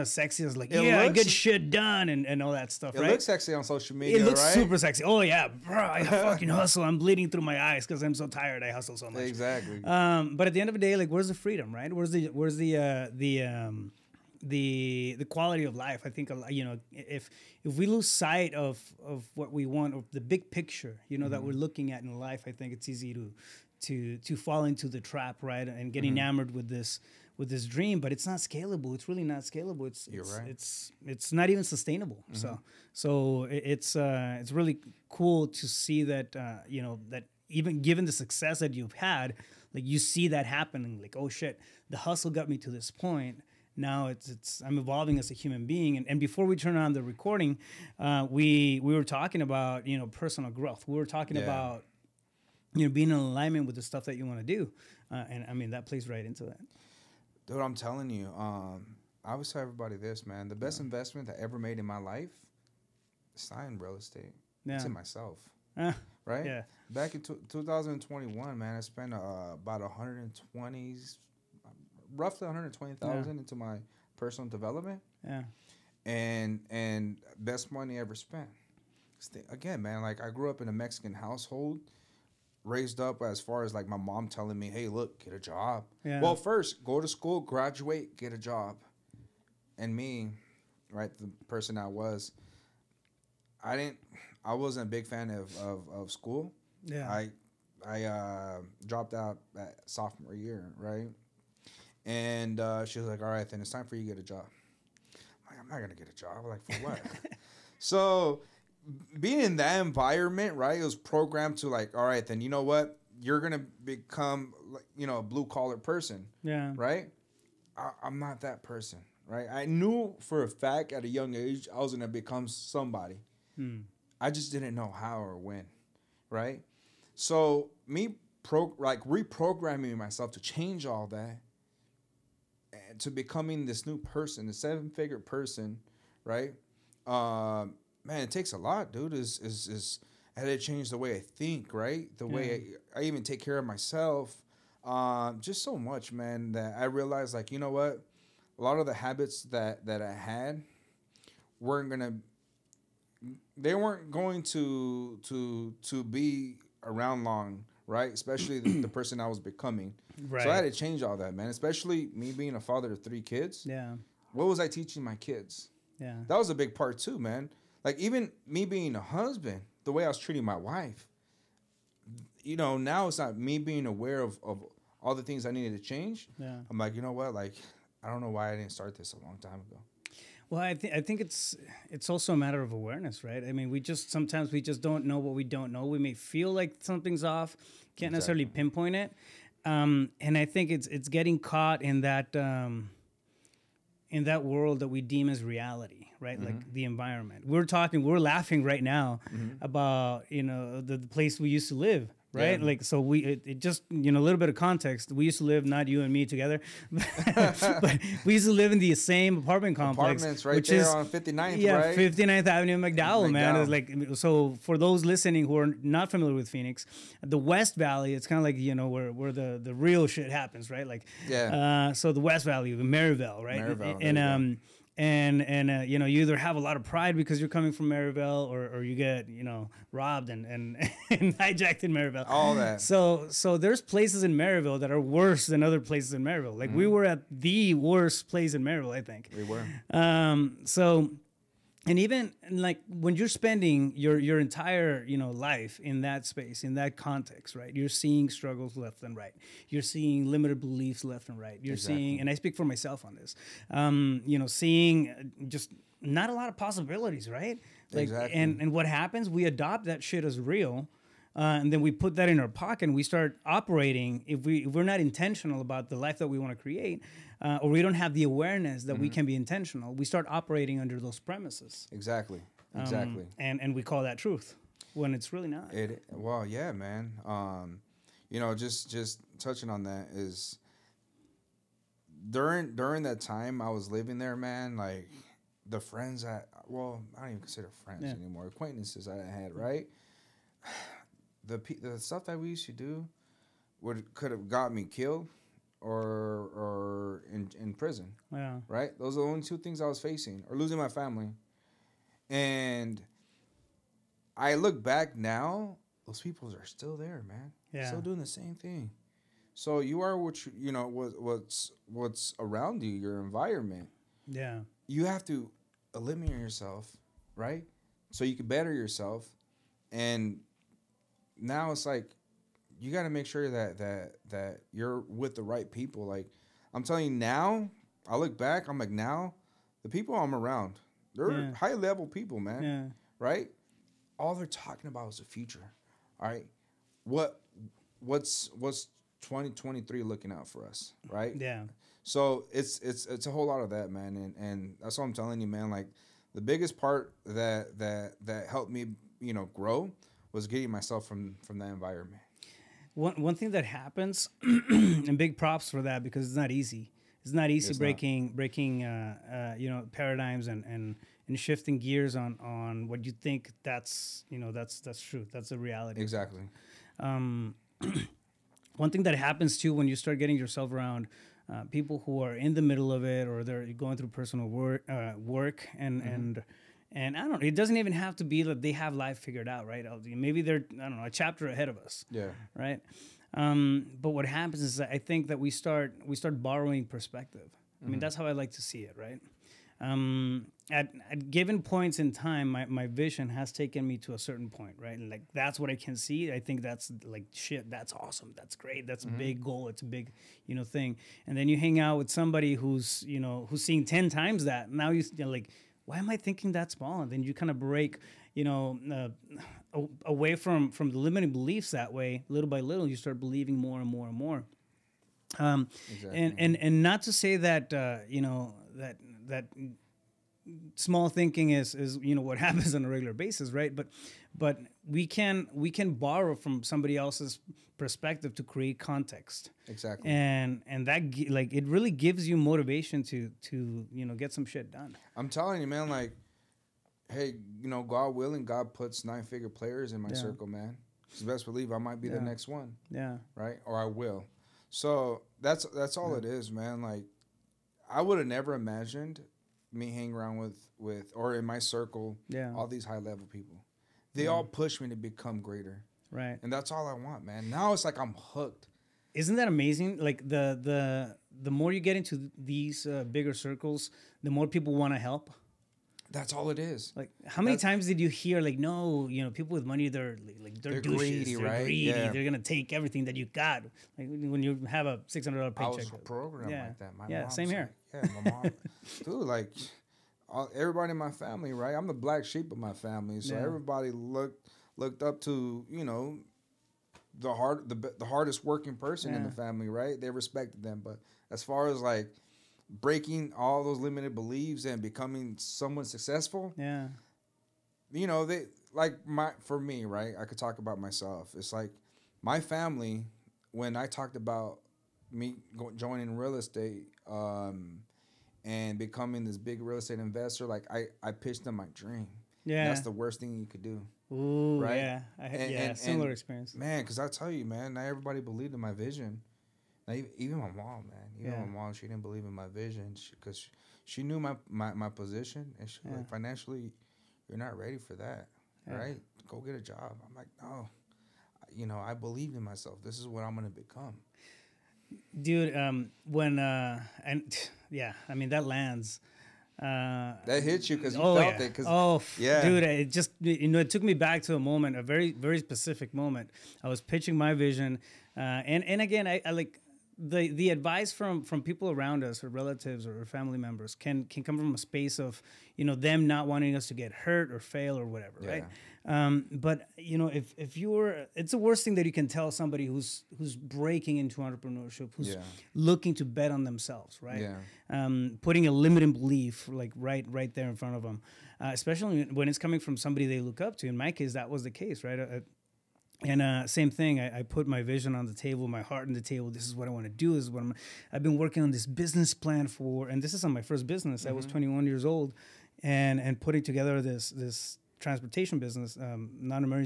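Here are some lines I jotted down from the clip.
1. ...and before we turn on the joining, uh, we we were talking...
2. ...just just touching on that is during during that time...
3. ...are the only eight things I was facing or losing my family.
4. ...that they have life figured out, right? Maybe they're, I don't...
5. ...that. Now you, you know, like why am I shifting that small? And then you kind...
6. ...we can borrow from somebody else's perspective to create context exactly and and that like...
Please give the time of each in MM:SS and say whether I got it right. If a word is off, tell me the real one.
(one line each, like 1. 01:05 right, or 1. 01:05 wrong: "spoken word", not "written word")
1. 00:46 wrong: "recording", not "joining"
2. 04:38 right
3. 04:59 wrong: "two", not "eight"
4. 06:18 right
5. 06:44 wrong: "thinking", not "shifting"
6. 07:05 right.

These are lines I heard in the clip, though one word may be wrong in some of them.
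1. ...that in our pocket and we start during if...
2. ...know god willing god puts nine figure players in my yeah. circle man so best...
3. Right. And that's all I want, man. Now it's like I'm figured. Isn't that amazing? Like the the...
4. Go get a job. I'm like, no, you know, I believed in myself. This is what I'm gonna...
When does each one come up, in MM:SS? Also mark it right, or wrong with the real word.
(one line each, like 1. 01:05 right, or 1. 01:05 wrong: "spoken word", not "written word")
1. 04:22 wrong: "operating", not "during"
2. 07:17 right
3. 07:36 wrong: "hooked", not "figured"
4. 08:49 right.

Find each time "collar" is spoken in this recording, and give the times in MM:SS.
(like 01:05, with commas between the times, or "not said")
01:55.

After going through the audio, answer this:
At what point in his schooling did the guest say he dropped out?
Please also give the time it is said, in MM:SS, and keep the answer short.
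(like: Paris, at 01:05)
Sophomore year, at 01:39.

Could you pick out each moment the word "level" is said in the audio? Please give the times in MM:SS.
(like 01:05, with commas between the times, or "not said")
05:31, 07:32.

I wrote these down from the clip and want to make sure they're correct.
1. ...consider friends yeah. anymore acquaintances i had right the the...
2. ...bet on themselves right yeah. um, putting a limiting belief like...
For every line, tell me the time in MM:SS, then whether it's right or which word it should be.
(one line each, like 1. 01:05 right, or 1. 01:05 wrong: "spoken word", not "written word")
1. 04:47 right
2. 09:26 right.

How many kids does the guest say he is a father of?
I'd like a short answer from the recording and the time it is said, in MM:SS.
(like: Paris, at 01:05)
3, at 02:43.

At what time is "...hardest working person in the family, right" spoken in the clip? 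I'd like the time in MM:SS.
08:08.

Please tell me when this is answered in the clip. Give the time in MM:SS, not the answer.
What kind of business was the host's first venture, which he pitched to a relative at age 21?
09:47.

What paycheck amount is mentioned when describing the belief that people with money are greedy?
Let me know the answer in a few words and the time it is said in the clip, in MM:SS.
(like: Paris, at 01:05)
$600, at 07:55.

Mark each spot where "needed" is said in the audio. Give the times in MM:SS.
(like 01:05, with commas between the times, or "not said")
02:55.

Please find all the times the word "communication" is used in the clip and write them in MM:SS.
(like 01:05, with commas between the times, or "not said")
not said.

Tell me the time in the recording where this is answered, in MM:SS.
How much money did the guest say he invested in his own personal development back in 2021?
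01:12.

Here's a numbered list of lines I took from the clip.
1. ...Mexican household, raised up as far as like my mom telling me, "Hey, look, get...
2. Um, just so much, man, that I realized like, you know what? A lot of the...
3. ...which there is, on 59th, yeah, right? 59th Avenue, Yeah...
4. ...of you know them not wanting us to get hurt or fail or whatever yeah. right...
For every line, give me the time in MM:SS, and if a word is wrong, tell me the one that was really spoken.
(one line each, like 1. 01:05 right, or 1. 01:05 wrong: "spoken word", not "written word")
1. 01:20 right
2. 02:24 right
3. 03:30 wrong: "McDowell", not "Yeah"
4. 09:14 right.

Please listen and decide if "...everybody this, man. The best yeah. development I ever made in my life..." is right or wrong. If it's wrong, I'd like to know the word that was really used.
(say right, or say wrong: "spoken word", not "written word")
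wrong: "investment", not "development".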